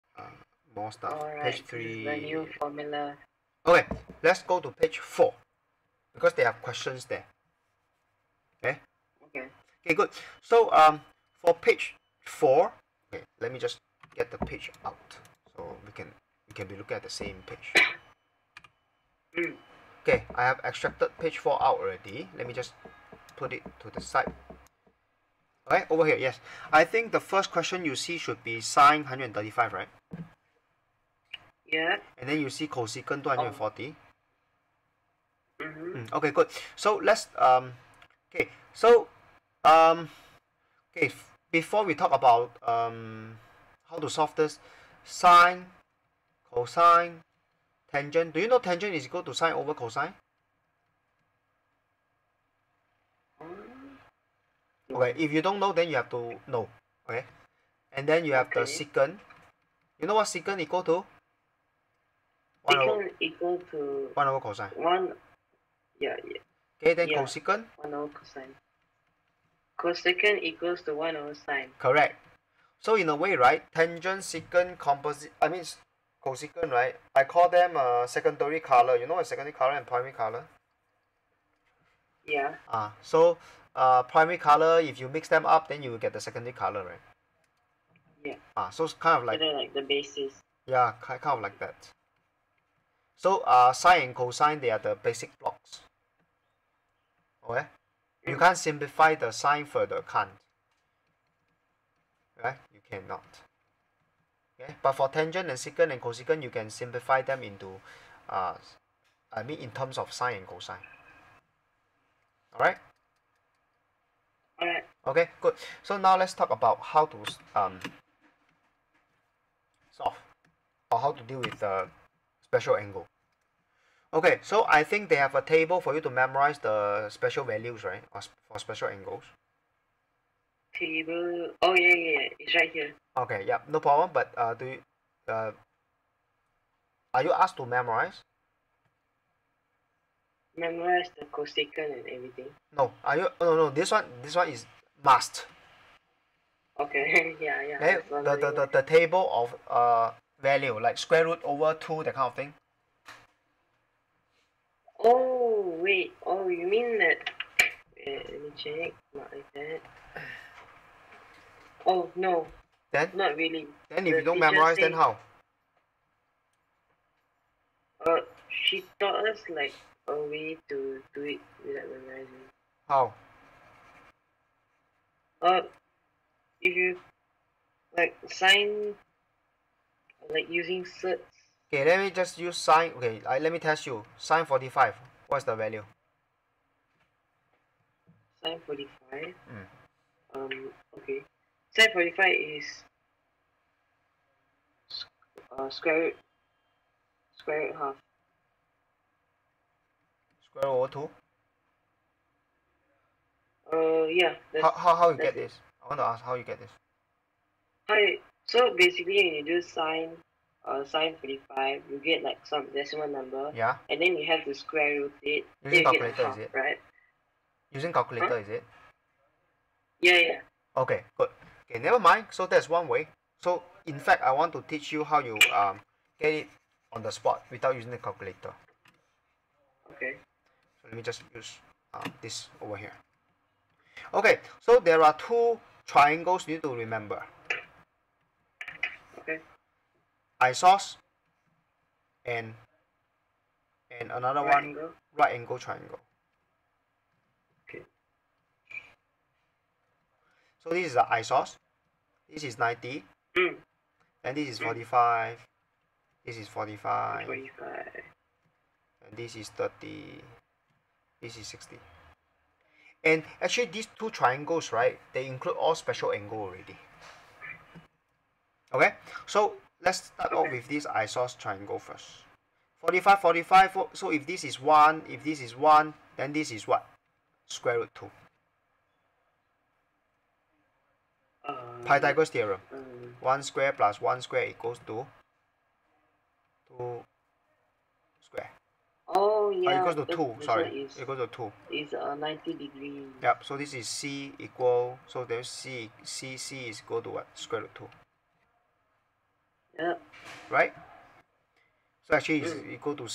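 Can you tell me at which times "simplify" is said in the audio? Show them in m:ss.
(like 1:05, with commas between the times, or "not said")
1:38, 1:46.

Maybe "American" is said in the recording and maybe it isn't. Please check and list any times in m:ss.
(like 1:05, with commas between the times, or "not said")
not said.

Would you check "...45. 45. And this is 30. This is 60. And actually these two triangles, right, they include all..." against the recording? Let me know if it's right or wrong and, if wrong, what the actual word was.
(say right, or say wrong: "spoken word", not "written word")
right.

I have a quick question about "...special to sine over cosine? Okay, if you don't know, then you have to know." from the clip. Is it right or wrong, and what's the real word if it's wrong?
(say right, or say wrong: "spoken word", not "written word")
wrong: "equal", not "special".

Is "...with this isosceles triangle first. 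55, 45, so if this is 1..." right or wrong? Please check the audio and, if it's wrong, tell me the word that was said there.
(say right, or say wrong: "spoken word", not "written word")
wrong: "45", not "55".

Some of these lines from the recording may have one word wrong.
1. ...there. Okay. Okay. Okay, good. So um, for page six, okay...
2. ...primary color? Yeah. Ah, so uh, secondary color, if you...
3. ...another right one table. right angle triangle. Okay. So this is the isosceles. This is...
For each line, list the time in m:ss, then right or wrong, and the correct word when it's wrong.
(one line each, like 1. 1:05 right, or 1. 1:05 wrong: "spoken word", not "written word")
1. 0:07 wrong: "four", not "six"
2. 1:19 wrong: "primary", not "secondary"
3. 4:04 wrong: "angle", not "table".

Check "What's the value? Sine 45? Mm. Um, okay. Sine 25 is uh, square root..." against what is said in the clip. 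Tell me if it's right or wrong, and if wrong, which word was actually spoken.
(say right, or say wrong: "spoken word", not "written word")
wrong: "45", not "25".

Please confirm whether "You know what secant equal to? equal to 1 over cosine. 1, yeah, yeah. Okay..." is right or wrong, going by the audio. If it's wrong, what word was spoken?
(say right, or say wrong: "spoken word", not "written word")
right.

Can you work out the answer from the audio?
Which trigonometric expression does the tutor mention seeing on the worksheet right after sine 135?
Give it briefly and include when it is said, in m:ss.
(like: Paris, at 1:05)
cosecant 240, at 0:32.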